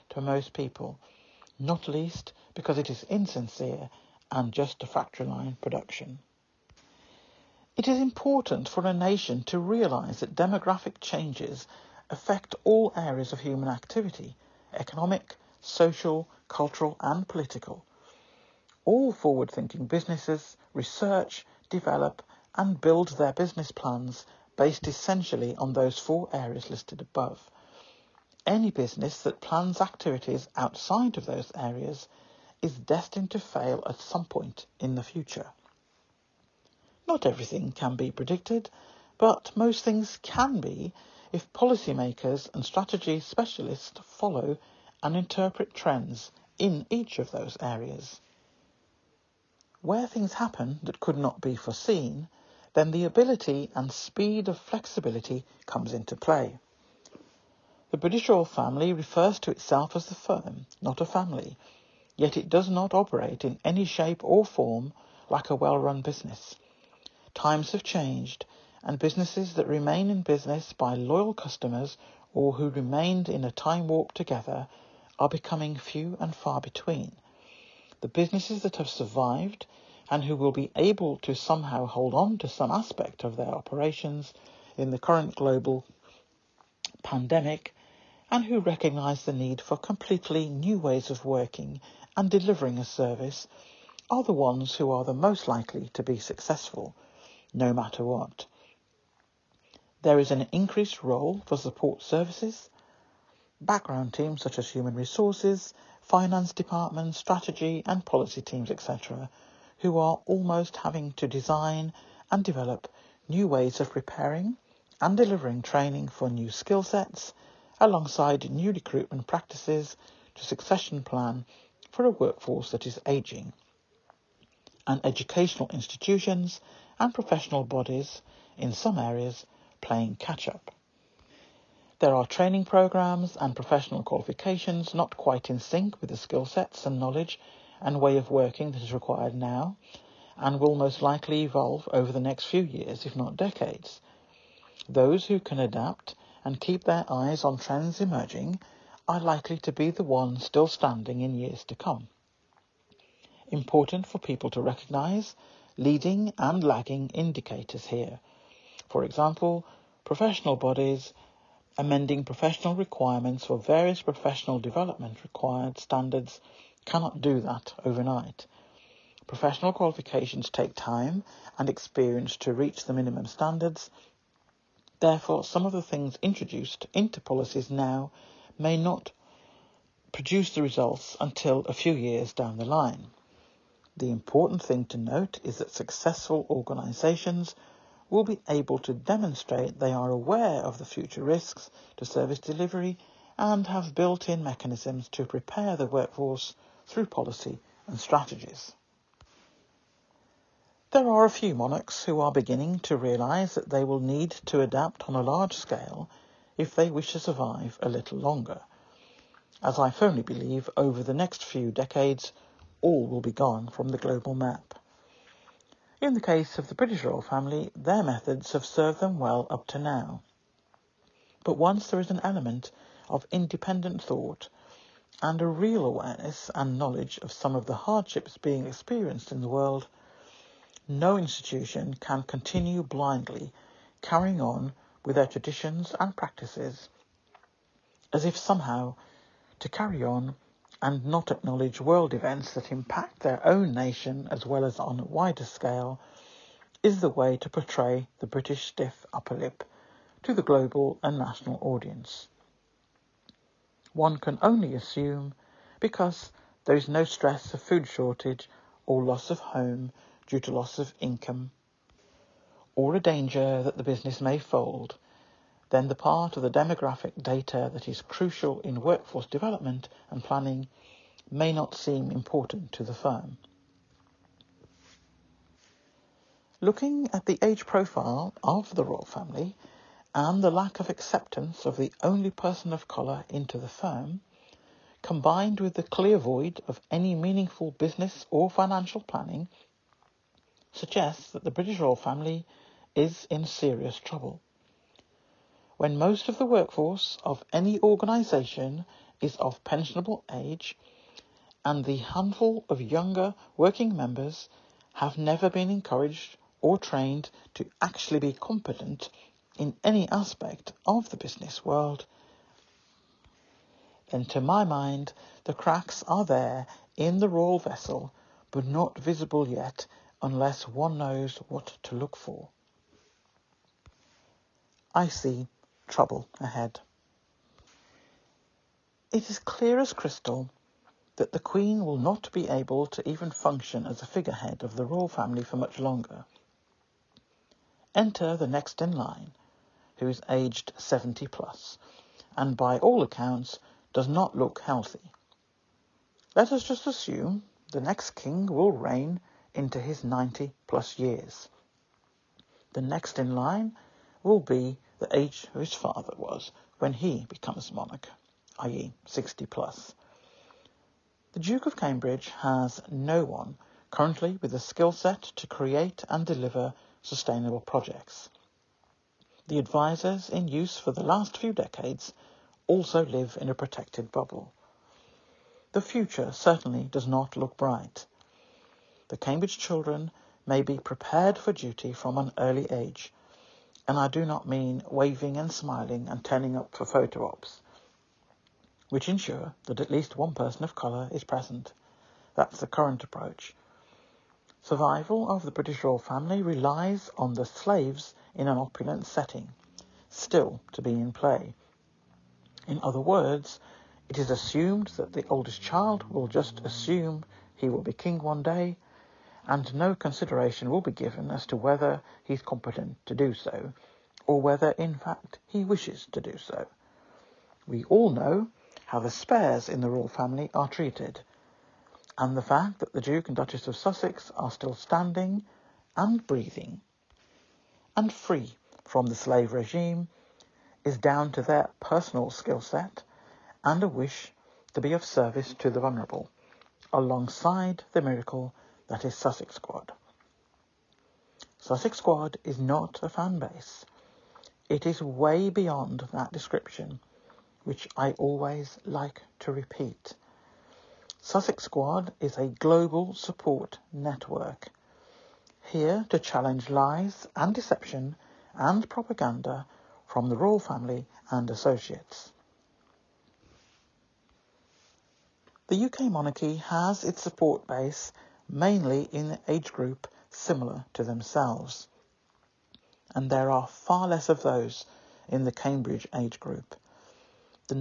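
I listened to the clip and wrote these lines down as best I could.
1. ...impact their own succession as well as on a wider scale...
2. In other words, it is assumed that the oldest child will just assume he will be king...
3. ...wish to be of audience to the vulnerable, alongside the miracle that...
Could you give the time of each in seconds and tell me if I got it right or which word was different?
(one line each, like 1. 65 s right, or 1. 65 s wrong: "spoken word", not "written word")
1. 242 s wrong: "nation", not "succession"
2. 402 s right
3. 433 s wrong: "service", not "audience".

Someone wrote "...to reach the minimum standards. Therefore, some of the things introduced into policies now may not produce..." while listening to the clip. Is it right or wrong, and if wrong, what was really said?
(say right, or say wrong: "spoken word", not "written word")
right.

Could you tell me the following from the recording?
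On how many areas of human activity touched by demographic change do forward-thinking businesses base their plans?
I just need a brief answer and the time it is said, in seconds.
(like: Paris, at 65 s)
4, at 25 s.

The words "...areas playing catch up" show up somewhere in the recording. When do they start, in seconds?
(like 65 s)
128 s.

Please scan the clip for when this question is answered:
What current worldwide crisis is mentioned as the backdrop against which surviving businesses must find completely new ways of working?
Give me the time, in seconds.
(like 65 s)
85 s.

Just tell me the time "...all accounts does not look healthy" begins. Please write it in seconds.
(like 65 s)
342 s.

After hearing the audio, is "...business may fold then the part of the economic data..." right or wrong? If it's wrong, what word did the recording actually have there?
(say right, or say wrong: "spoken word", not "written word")
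wrong: "demographic", not "economic".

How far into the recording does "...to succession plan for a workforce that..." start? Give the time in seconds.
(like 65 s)
120 s.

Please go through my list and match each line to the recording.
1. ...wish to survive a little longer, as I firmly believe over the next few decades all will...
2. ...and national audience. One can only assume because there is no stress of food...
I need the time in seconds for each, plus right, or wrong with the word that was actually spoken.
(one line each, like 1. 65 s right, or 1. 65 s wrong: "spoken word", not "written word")
1. 206 s right
2. 251 s right.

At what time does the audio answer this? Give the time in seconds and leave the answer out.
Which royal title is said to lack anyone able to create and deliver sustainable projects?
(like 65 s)
361 s.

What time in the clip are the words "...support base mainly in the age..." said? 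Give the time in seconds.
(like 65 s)
467 s.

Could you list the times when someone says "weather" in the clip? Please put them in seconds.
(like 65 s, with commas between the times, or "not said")
not said.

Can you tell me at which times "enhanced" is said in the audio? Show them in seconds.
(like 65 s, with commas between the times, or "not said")
not said.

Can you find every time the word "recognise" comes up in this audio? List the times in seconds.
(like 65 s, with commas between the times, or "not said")
88 s, 154 s.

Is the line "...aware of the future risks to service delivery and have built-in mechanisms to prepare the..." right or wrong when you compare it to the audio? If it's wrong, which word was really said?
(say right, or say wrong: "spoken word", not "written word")
right.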